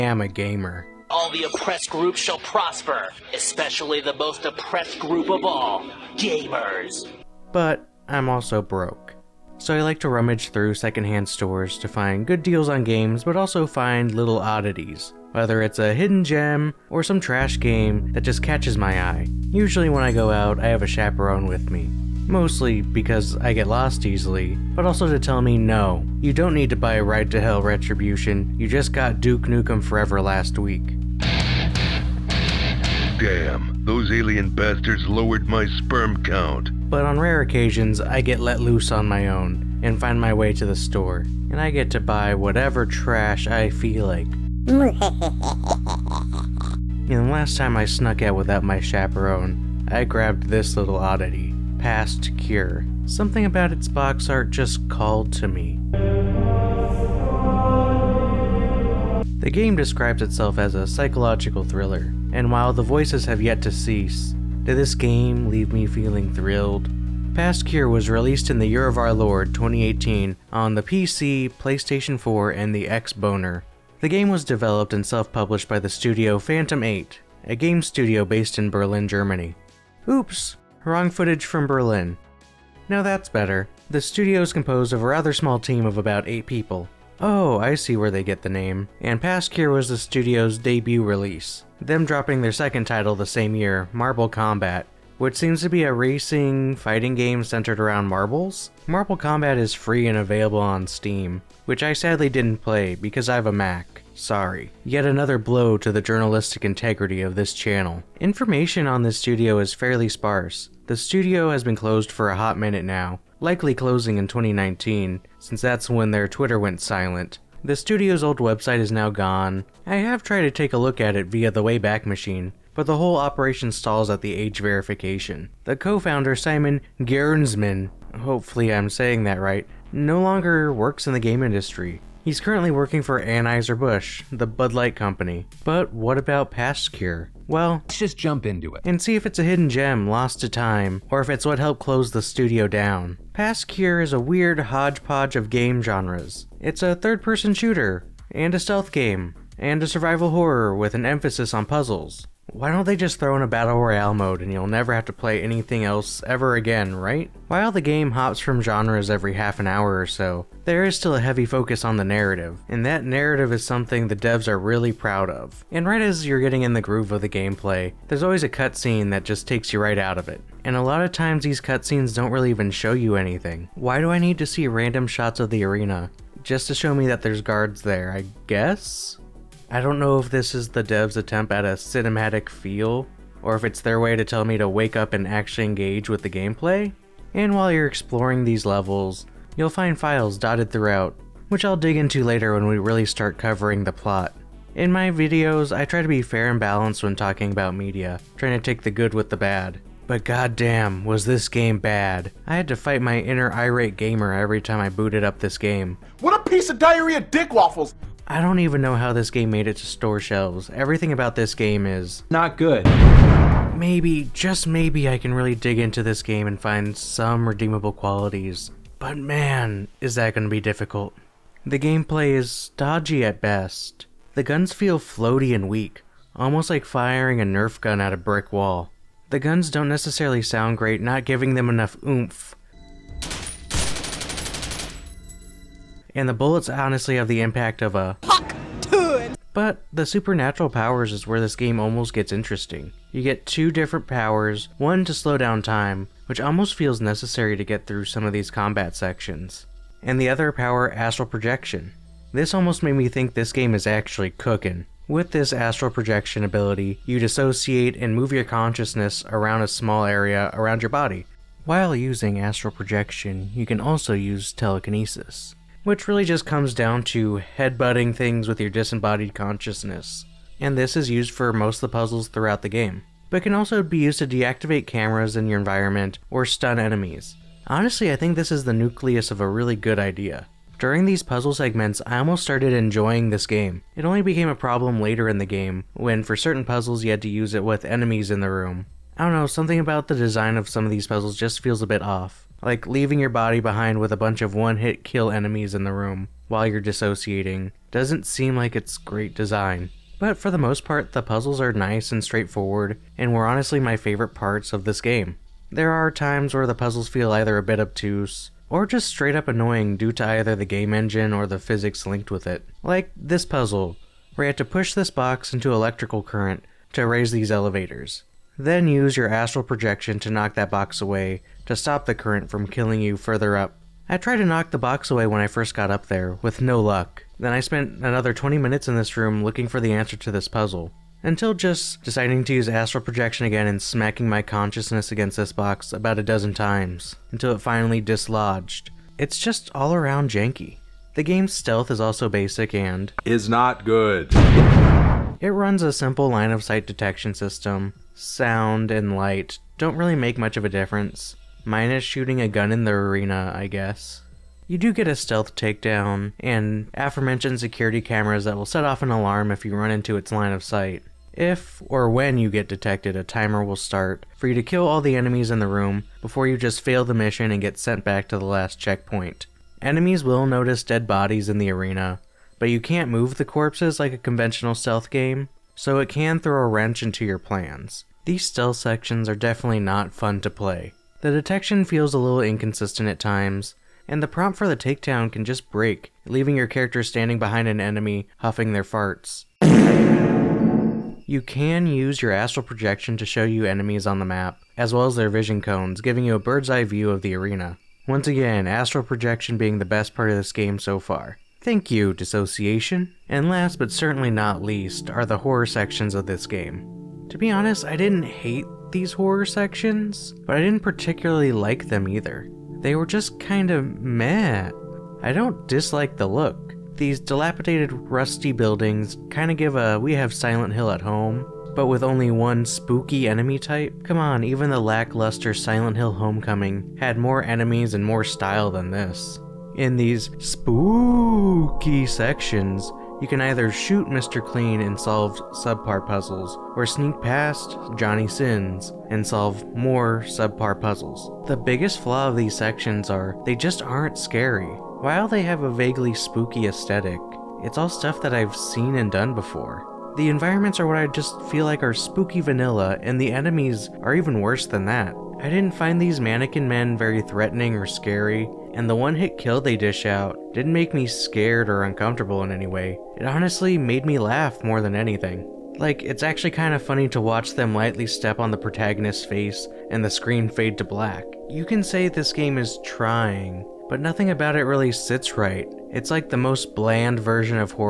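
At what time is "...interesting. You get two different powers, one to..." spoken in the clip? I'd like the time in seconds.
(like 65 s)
242 s.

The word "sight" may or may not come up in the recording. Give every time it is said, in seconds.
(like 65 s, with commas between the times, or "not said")
346 s, 360 s.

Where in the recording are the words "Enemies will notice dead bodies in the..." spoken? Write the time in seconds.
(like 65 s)
369 s.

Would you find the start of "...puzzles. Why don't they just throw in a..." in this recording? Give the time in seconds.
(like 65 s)
151 s.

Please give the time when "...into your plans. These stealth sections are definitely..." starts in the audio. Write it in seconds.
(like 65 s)
377 s.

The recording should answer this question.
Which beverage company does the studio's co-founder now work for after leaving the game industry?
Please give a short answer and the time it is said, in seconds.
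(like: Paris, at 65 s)
Anheuser-Busch, at 133 s.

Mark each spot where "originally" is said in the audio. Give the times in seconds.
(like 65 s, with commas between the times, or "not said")
not said.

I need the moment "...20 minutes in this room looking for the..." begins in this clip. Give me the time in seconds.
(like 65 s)
328 s.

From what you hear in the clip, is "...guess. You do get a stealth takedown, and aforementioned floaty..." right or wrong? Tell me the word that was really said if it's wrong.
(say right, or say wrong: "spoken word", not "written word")
wrong: "security", not "floaty".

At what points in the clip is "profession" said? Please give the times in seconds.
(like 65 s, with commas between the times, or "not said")
not said.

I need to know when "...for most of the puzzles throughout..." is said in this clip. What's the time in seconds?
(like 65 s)
271 s.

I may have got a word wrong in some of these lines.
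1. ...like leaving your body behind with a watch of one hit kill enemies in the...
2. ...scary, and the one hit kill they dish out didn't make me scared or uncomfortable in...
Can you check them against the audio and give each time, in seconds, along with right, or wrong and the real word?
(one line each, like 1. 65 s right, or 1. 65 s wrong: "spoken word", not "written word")
1. 292 s wrong: "bunch", not "watch"
2. 457 s right.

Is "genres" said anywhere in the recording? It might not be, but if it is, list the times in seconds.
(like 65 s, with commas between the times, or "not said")
145 s, 158 s.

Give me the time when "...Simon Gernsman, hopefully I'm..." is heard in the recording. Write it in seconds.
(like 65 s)
126 s.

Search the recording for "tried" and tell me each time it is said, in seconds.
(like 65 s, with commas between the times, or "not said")
120 s, 324 s.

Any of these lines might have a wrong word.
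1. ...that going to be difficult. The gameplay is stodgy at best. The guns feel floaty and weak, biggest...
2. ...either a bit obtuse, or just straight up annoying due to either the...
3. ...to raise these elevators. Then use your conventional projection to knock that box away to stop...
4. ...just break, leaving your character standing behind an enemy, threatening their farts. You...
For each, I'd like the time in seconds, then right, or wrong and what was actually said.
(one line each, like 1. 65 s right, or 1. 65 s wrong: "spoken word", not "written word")
1. 220 s wrong: "almost", not "biggest"
2. 307 s right
3. 316 s wrong: "astral", not "conventional"
4. 385 s wrong: "huffing", not "threatening".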